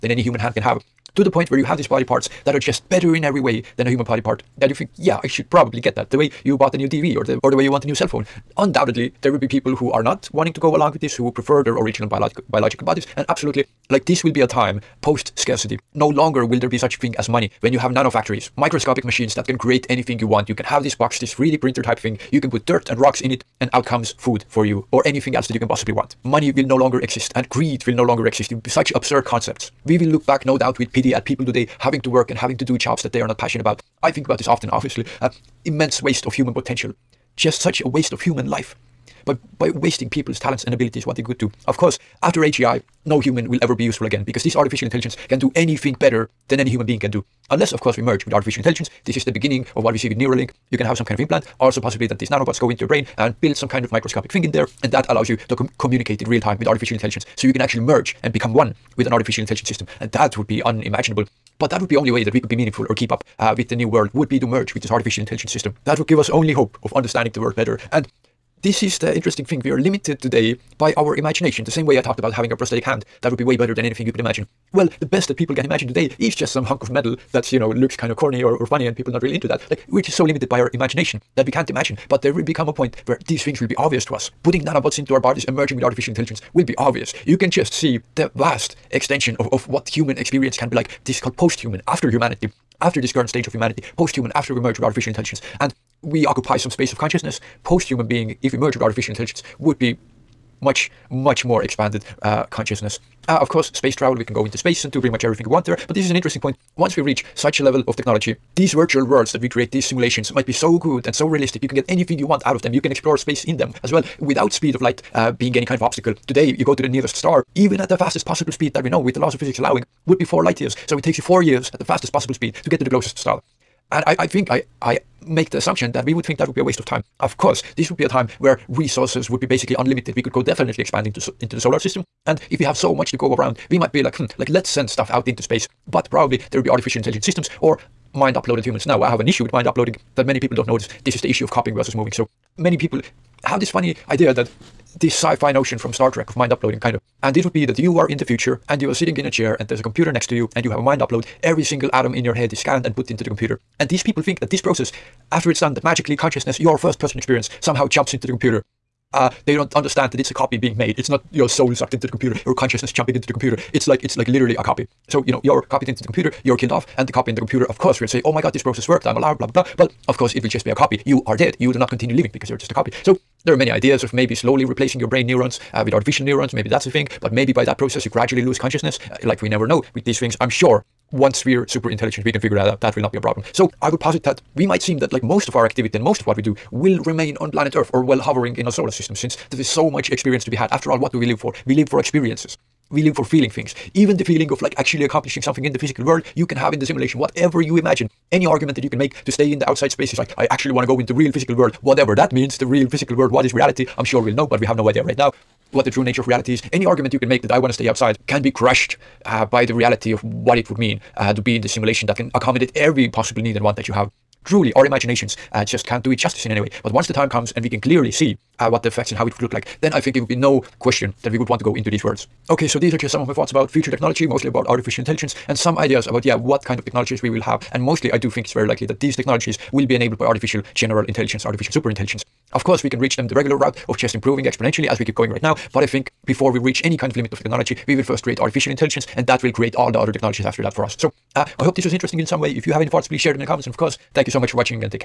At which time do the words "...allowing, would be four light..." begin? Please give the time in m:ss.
1:59.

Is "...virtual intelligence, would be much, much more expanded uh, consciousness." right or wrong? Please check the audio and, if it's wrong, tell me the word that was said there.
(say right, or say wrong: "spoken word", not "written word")
wrong: "artificial", not "virtual".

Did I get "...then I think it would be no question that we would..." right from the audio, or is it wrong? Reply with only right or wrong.
right.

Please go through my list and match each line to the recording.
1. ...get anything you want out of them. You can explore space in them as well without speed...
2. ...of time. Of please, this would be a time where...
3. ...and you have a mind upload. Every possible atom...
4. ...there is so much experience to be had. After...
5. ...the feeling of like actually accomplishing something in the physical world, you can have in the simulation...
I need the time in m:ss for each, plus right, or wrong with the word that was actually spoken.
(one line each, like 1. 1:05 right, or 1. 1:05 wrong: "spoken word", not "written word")
1. 1:51 right
2. 2:06 wrong: "course", not "please"
3. 2:30 wrong: "single", not "possible"
4. 3:09 right
5. 3:14 right.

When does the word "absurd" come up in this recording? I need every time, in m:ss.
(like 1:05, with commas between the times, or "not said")
0:28.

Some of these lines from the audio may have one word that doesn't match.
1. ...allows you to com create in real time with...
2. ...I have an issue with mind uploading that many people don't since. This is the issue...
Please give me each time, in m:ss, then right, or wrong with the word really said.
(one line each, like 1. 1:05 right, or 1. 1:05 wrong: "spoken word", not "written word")
1. 0:55 wrong: "communicate", not "create"
2. 2:19 wrong: "notice", not "since".